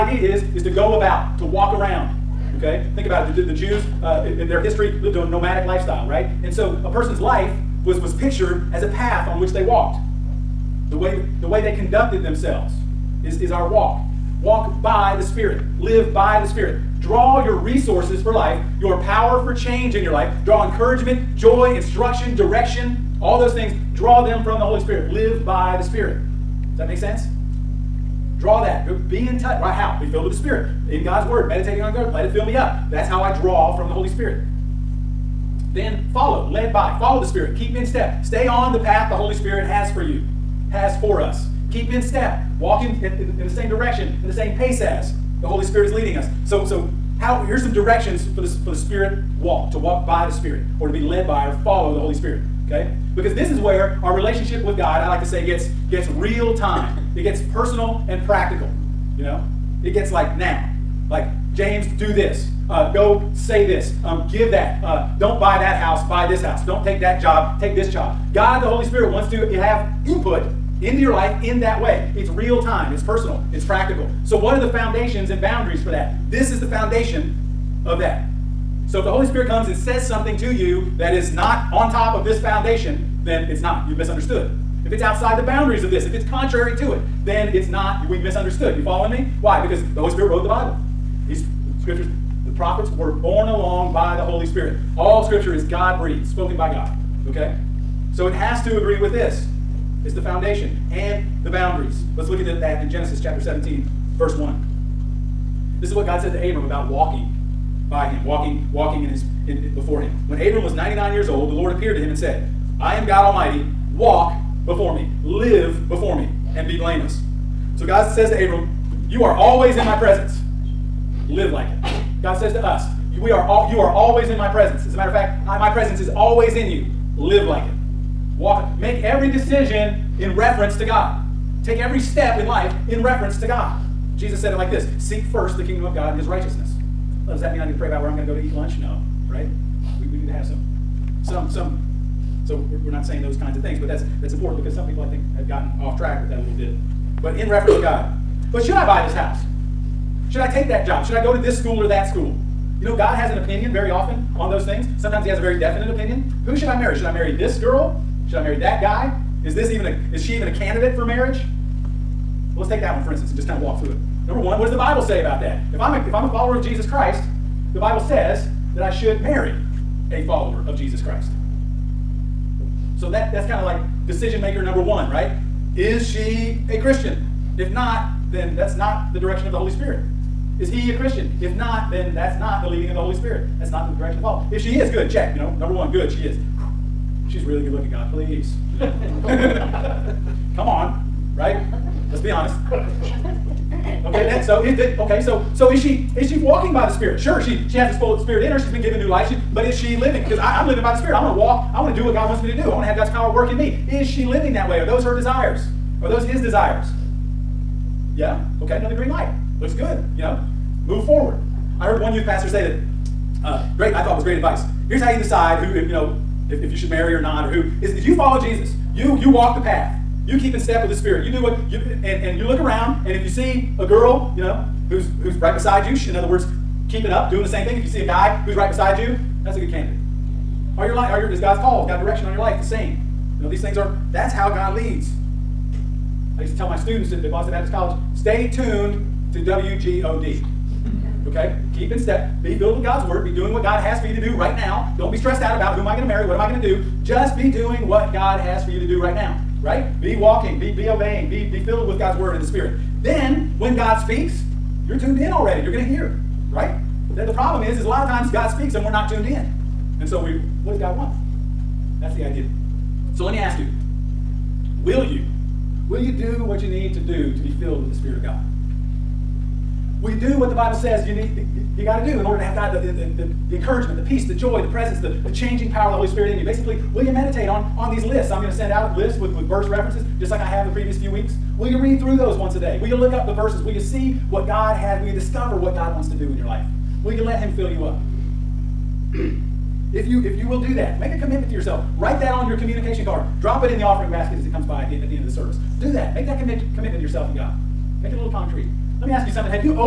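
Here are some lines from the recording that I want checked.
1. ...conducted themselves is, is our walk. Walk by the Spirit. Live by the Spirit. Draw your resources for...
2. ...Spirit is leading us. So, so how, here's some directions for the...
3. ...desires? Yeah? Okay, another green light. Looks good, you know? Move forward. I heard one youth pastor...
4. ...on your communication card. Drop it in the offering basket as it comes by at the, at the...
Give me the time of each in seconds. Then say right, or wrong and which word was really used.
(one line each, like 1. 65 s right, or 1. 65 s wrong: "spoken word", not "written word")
1. 11 s right
2. 45 s right
3. 206 s right
4. 292 s right.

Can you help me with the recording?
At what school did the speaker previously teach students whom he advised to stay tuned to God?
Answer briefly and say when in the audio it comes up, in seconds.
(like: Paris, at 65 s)
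Boston Baptist College, at 237 s.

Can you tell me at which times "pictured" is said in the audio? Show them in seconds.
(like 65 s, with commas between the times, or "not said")
8 s.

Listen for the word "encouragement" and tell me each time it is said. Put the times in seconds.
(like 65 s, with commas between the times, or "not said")
20 s, 273 s.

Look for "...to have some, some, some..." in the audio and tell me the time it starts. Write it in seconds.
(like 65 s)
140 s.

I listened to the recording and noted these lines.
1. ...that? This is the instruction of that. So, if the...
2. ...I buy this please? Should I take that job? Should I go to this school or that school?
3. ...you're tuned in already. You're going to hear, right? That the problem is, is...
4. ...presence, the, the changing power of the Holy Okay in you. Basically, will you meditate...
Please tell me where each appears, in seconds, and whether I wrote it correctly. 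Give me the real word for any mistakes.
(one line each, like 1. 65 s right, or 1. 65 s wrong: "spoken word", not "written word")
1. 75 s wrong: "foundation", not "instruction"
2. 148 s wrong: "house", not "please"
3. 254 s right
4. 274 s wrong: "Spirit", not "Okay".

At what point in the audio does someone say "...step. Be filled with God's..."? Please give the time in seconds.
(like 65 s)
241 s.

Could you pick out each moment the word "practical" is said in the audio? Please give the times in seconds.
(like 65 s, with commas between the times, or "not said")
58 s, 73 s.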